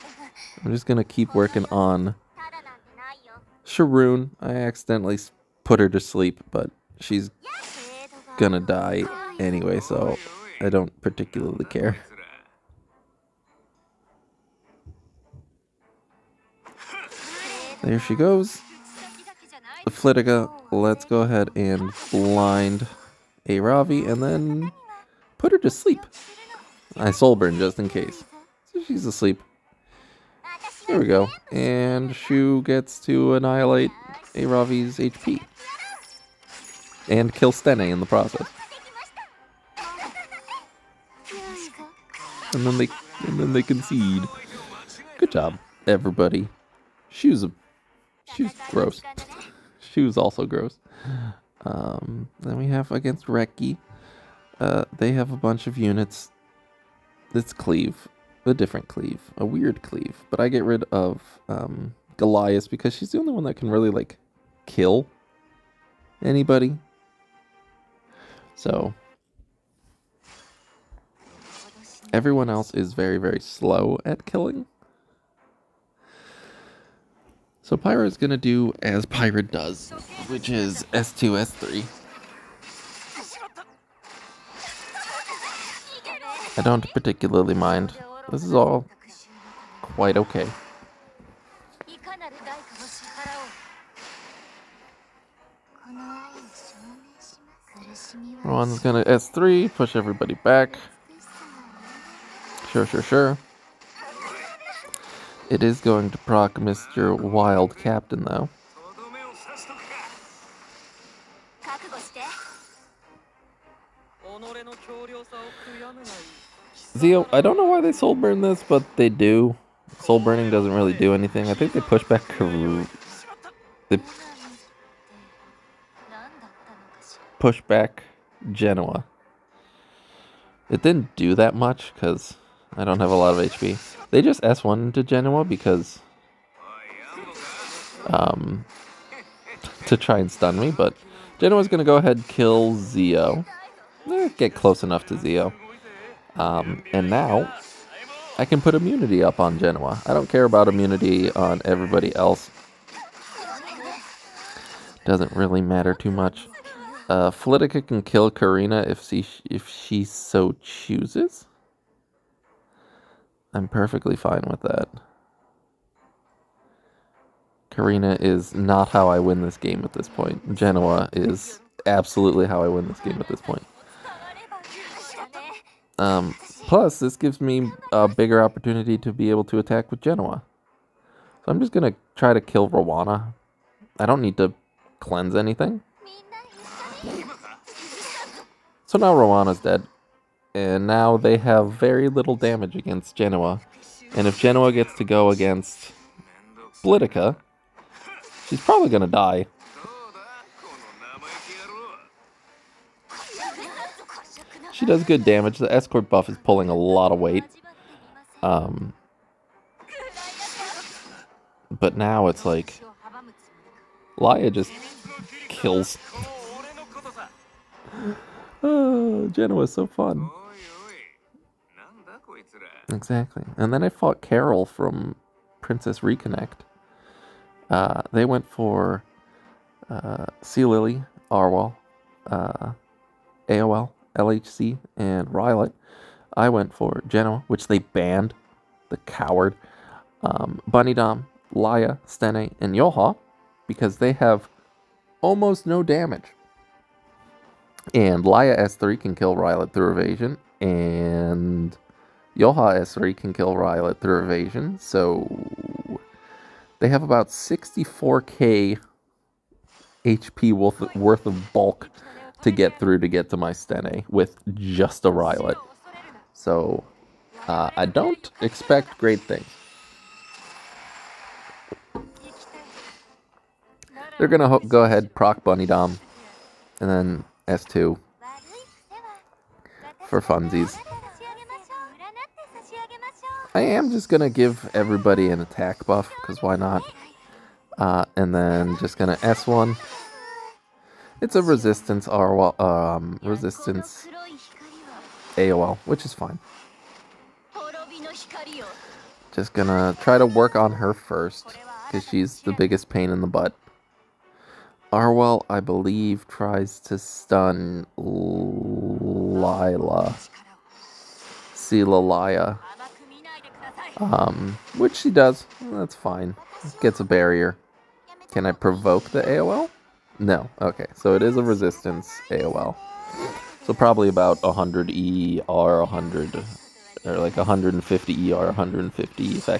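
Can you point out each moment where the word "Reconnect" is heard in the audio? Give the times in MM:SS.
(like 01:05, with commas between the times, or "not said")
03:46.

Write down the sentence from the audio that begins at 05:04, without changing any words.
Arowell, I believe, tries to stun Lila.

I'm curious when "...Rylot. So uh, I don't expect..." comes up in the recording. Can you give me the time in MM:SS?
04:25.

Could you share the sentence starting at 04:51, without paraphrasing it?
It's a resistance R um, resistance AOL, which is fine.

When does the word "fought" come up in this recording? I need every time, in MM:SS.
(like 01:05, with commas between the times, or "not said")
03:43.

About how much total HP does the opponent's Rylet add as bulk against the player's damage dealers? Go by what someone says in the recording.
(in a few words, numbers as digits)
64k.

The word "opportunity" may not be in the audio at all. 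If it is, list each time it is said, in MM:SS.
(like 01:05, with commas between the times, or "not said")
02:58.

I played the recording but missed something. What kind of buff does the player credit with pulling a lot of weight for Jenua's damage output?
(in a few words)
escort buff.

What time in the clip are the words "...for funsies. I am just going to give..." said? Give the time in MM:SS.
04:40.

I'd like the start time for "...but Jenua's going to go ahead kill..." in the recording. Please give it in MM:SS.
02:20.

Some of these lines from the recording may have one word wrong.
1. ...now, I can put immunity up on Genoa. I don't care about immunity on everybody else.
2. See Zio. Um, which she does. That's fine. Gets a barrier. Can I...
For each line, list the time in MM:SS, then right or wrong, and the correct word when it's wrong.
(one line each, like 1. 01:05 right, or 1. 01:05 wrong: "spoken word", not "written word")
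1. 02:27 right
2. 05:11 wrong: "Lilia", not "Zio".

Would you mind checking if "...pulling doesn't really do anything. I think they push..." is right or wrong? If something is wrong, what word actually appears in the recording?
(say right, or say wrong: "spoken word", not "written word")
wrong: "burning", not "pulling".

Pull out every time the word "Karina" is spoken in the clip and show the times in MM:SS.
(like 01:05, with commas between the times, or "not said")
02:38, 02:47.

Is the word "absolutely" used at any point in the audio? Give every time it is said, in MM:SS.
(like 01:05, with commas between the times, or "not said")
02:51.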